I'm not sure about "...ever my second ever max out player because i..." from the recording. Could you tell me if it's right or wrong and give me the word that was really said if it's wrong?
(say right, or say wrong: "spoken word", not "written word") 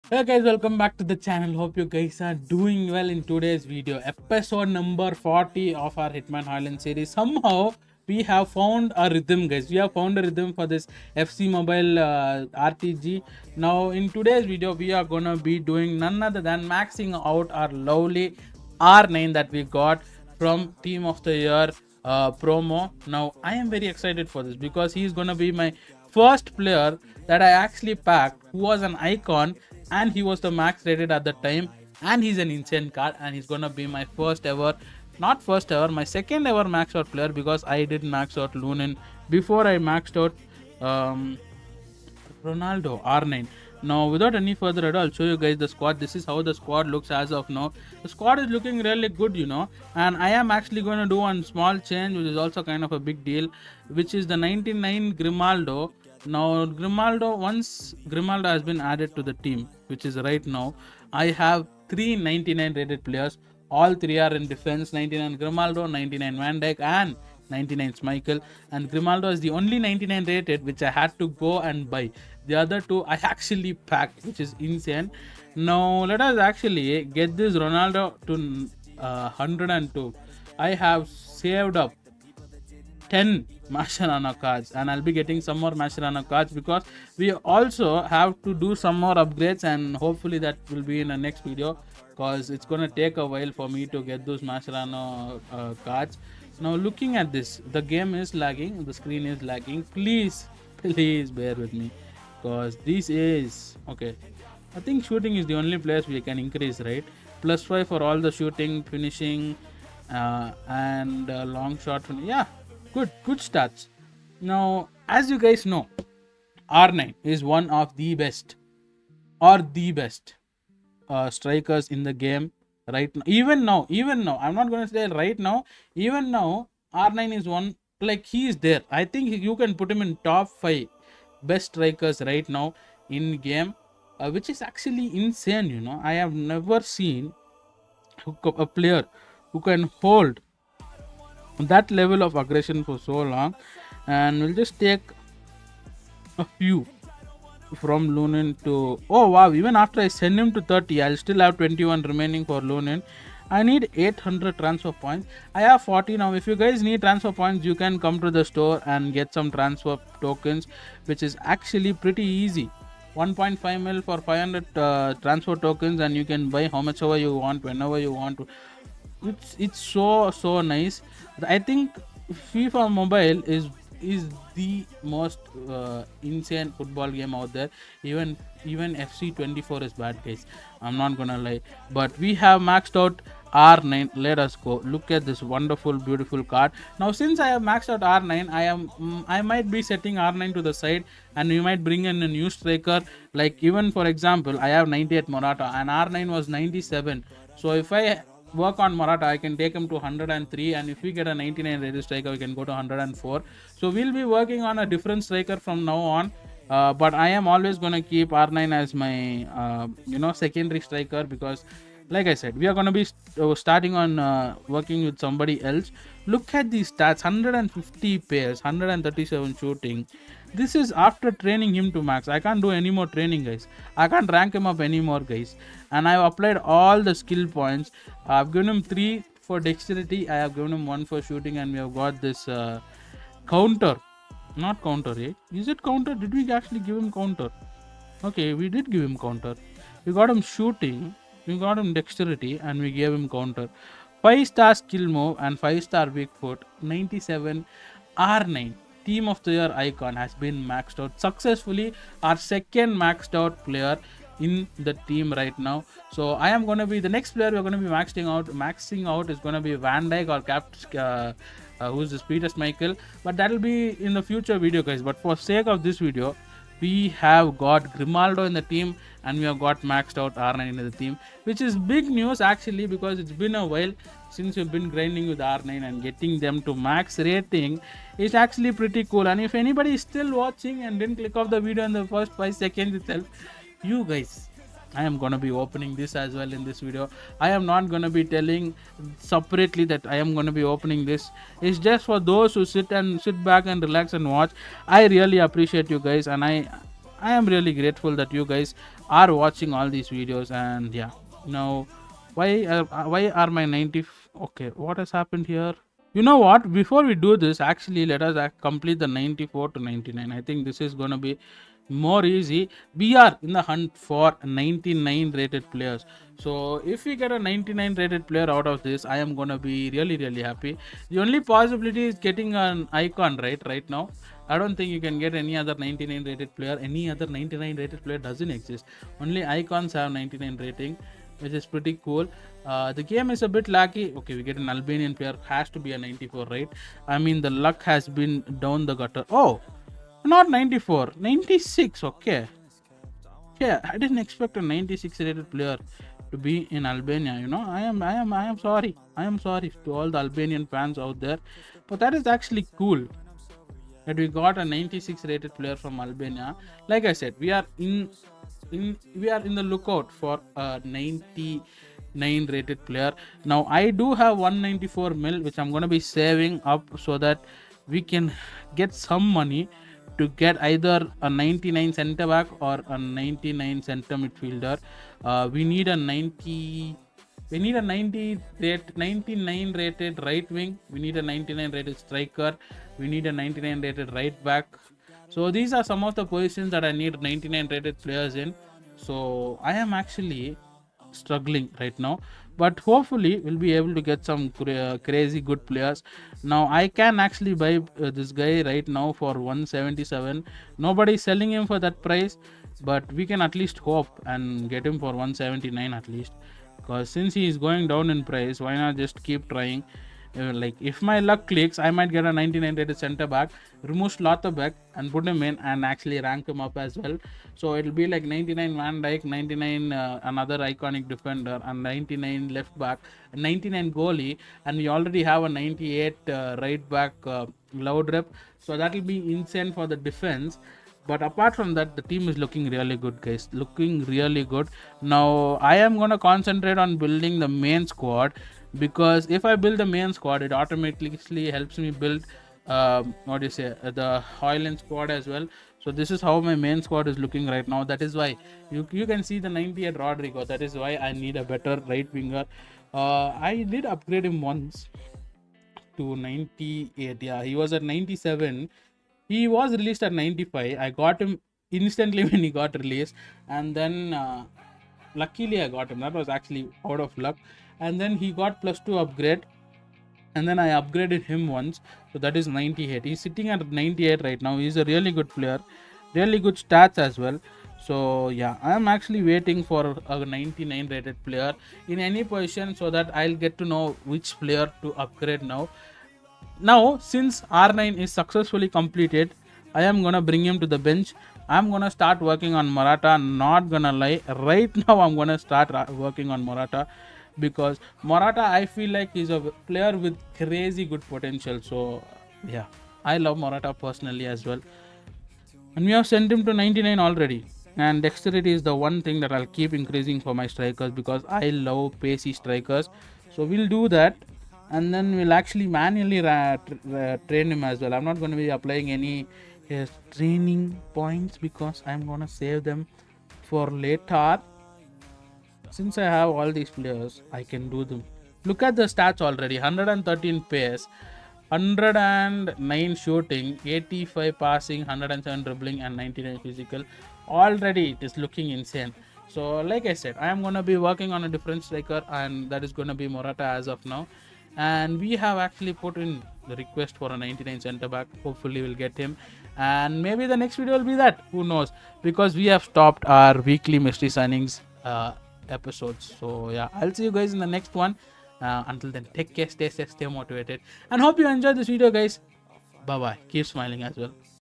right.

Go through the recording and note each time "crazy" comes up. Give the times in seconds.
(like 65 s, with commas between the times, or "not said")
394 s, 500 s.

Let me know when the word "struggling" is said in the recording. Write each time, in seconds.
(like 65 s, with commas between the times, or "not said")
391 s.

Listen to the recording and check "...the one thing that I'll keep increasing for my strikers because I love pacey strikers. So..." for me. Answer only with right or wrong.
right.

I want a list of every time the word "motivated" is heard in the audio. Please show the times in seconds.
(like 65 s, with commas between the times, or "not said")
560 s.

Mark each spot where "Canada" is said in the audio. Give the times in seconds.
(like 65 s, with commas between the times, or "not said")
not said.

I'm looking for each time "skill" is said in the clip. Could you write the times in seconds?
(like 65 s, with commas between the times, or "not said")
227 s, 244 s.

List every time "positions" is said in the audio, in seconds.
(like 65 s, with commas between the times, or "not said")
386 s, 482 s.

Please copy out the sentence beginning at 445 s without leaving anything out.
So this is how my main squad is looking right now.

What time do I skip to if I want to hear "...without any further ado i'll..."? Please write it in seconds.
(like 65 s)
44 s.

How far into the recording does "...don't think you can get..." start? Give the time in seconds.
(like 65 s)
324 s.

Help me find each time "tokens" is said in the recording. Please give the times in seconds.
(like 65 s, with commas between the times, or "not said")
160 s, 165 s.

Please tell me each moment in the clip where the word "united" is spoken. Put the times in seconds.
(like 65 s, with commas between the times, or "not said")
not said.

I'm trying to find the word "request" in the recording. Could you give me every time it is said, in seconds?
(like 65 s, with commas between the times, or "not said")
546 s.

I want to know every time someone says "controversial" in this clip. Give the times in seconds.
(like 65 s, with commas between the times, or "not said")
not said.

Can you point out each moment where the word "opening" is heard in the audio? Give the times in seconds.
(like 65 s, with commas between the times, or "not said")
285 s, 290 s.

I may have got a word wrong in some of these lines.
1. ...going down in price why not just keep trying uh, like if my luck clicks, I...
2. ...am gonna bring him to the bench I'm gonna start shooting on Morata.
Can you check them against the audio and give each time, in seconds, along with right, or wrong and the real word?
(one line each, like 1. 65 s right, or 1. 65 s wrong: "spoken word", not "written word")
1. 407 s right
2. 489 s wrong: "working", not "shooting".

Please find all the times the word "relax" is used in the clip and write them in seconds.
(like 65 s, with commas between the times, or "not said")
293 s.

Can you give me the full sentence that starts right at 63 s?
All three are in defense 99 Grimaldo, 99 Van Dijk, and 99 Michael.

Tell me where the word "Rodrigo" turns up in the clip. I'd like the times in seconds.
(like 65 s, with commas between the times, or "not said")
449 s.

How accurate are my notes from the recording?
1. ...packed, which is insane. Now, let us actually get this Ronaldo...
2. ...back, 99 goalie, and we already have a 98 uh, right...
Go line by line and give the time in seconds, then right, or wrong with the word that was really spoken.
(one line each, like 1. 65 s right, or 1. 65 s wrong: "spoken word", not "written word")
1. 73 s right
2. 422 s right.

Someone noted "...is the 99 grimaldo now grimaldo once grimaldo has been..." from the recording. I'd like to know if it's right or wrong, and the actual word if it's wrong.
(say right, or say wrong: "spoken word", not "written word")
right.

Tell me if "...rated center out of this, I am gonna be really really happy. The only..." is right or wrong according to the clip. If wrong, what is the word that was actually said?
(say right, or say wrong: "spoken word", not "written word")
wrong: "player", not "center".